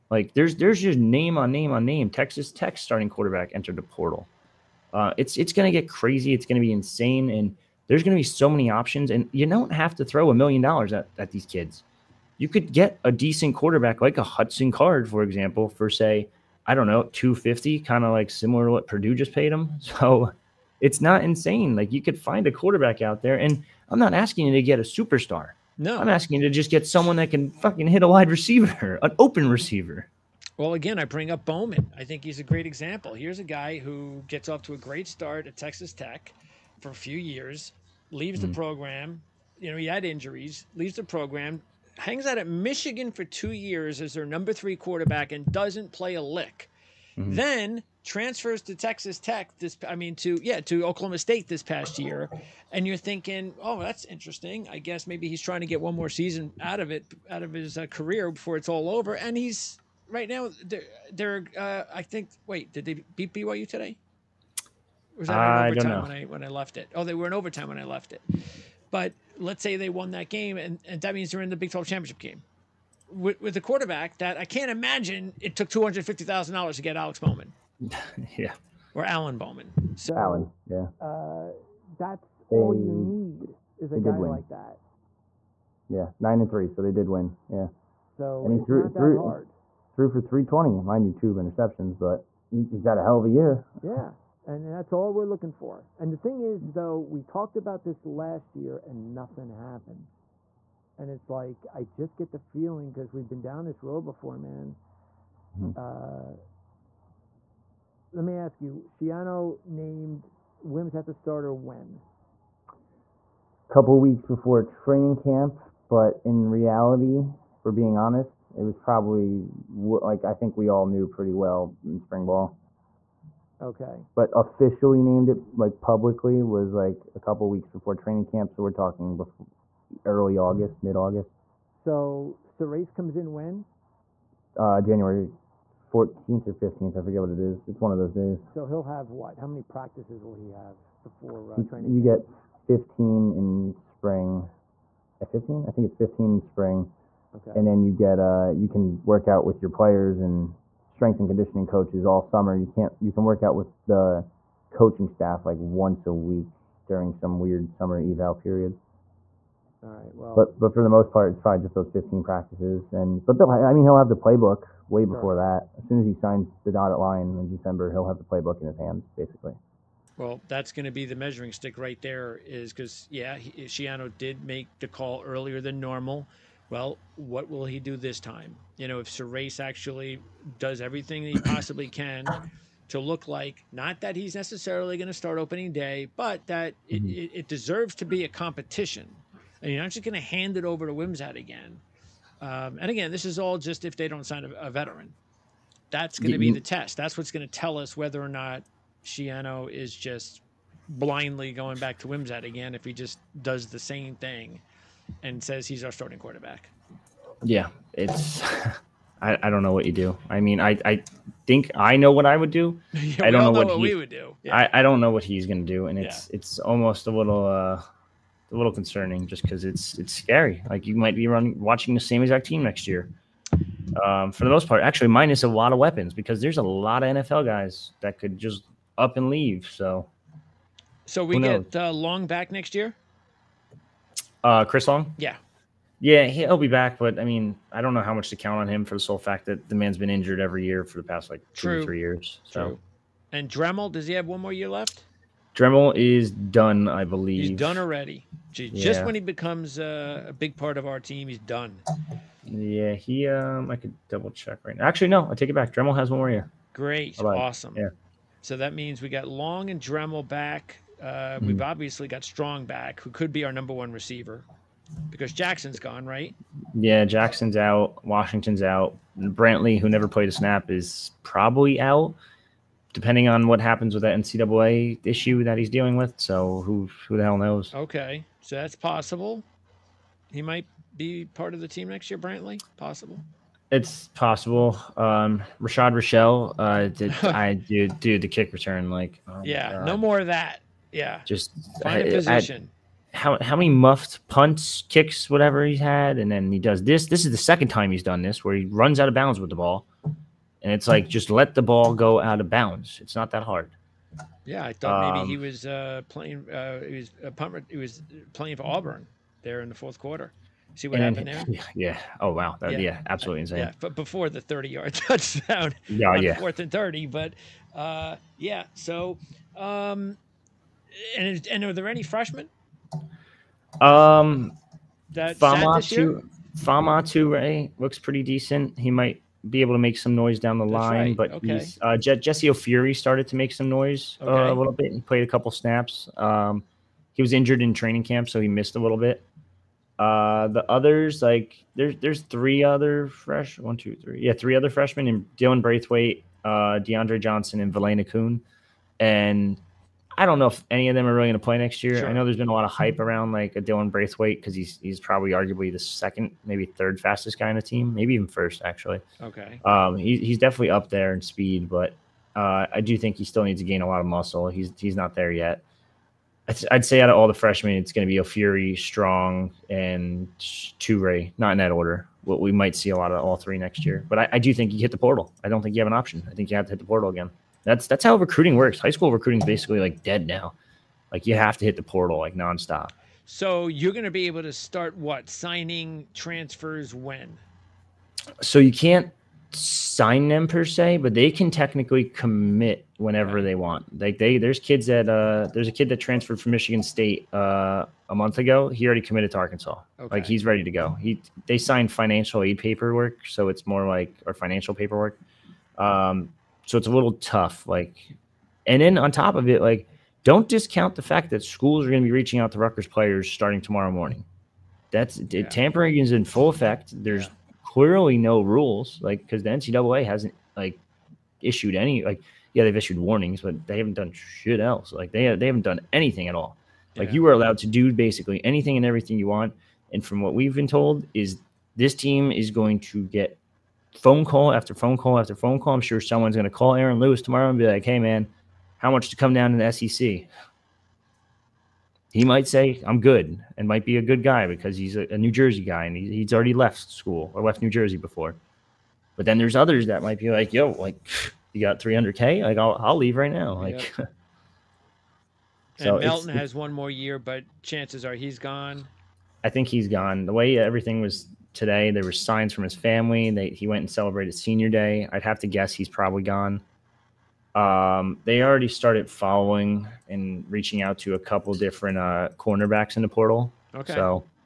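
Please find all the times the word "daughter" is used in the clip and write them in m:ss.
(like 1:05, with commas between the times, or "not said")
not said.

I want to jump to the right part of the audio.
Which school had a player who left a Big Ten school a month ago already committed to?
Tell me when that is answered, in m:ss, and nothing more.
6:39.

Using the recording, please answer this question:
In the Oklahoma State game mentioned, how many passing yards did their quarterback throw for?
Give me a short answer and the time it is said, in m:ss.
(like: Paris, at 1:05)
320, at 1:30.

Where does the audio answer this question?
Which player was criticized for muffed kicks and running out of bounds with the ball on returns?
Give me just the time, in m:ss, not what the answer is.
4:45.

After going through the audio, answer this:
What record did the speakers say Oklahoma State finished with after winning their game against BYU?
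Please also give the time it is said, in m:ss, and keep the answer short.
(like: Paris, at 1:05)
9-3, at 1:26.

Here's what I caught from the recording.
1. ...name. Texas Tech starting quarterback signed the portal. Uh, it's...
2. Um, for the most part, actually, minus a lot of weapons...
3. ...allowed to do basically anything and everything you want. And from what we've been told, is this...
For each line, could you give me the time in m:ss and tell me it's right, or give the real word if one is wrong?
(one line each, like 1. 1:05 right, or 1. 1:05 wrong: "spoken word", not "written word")
1. 0:01 wrong: "entered", not "signed"
2. 3:44 right
3. 7:07 right.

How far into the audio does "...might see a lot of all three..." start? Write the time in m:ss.
6:12.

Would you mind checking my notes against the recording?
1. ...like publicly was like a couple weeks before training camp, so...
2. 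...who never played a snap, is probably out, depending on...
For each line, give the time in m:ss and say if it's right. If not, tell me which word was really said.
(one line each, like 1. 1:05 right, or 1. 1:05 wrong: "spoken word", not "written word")
1. 2:05 right
2. 4:29 right.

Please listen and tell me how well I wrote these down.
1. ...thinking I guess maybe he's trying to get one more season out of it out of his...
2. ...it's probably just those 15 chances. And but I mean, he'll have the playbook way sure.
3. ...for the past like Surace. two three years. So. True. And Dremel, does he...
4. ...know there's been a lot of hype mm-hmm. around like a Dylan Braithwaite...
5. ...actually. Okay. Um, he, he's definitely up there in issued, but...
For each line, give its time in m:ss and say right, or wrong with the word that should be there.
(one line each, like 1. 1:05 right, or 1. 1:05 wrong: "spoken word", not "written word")
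1. 0:54 wrong: "interesting", not "thinking"
2. 2:41 wrong: "practices", not "chances"
3. 4:00 wrong: "True", not "Surace"
4. 5:52 right
5. 5:58 wrong: "speed", not "issued".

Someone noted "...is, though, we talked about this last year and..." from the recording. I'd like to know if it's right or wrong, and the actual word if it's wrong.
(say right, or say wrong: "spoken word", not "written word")
right.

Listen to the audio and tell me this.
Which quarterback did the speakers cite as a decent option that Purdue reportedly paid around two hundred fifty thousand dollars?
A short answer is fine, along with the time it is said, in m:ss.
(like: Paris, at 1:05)
Hudson Card, at 0:14.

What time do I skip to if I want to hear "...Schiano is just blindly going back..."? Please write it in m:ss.
3:19.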